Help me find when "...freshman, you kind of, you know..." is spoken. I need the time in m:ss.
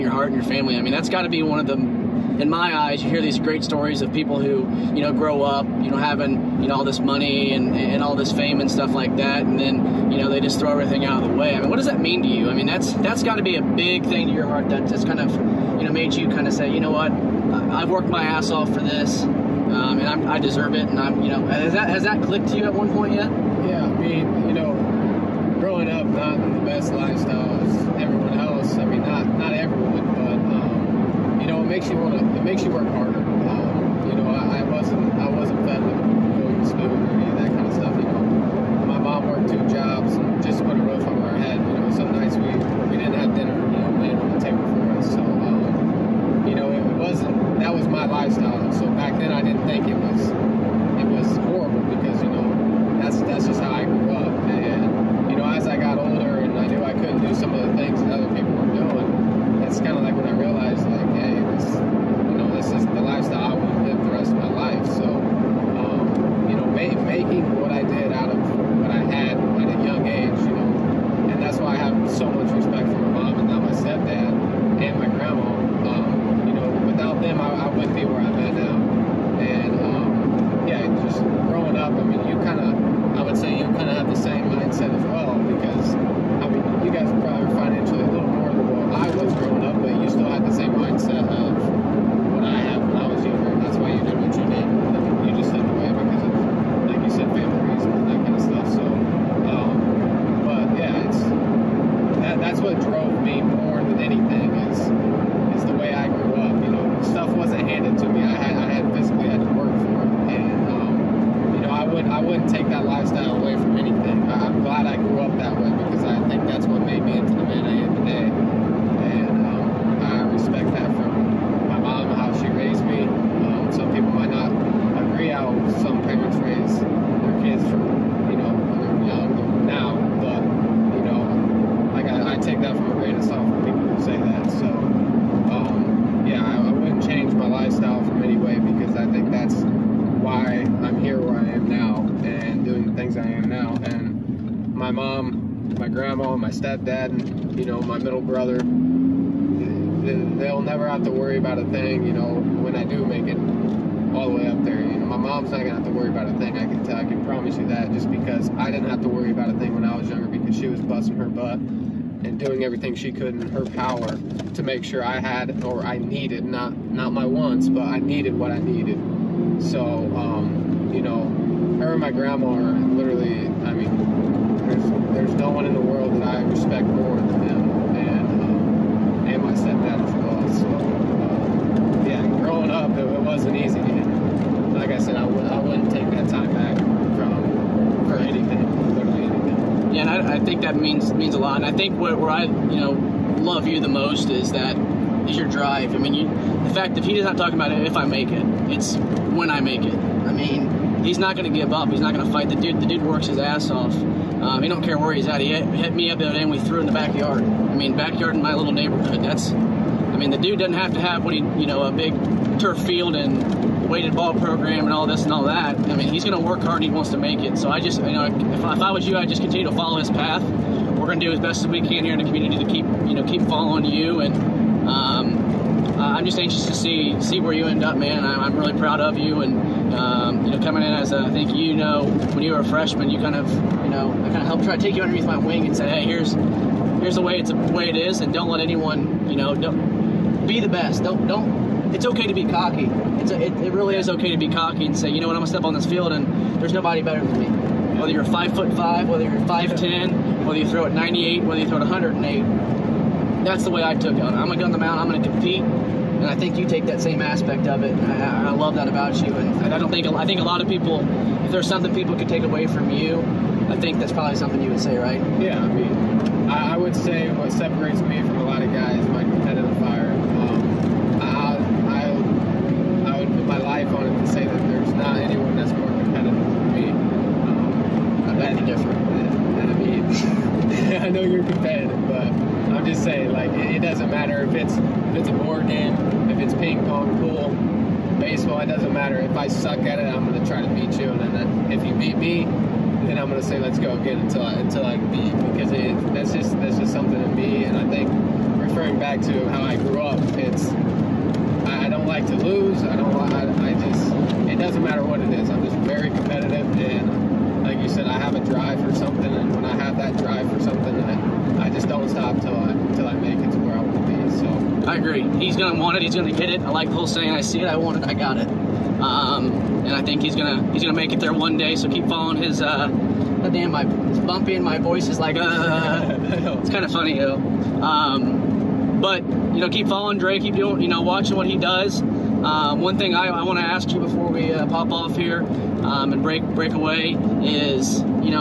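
3:52.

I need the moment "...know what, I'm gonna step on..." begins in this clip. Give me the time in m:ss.
4:05.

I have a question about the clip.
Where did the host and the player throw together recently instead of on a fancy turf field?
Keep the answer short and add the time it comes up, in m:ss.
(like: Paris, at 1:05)
The backyard, at 3:26.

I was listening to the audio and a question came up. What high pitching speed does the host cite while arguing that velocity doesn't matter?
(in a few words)
108.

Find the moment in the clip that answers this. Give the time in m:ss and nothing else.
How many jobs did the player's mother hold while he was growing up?
0:39.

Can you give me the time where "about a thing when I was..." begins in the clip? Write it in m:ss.
2:39.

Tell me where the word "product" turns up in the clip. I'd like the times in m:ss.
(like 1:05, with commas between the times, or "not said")
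not said.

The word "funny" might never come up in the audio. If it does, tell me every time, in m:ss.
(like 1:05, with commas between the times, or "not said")
5:26.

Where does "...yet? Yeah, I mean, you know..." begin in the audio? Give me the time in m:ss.
0:23.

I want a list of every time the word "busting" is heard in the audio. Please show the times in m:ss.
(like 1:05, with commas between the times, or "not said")
2:40.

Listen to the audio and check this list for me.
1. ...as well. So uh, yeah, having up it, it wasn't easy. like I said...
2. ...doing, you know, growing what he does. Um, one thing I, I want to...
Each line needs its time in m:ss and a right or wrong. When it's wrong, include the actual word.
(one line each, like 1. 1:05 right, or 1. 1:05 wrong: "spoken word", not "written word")
1. 3:00 wrong: "growing", not "having"
2. 5:30 wrong: "watching", not "growing".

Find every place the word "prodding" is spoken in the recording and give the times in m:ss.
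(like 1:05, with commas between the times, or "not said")
not said.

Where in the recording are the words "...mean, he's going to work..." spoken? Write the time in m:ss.
3:35.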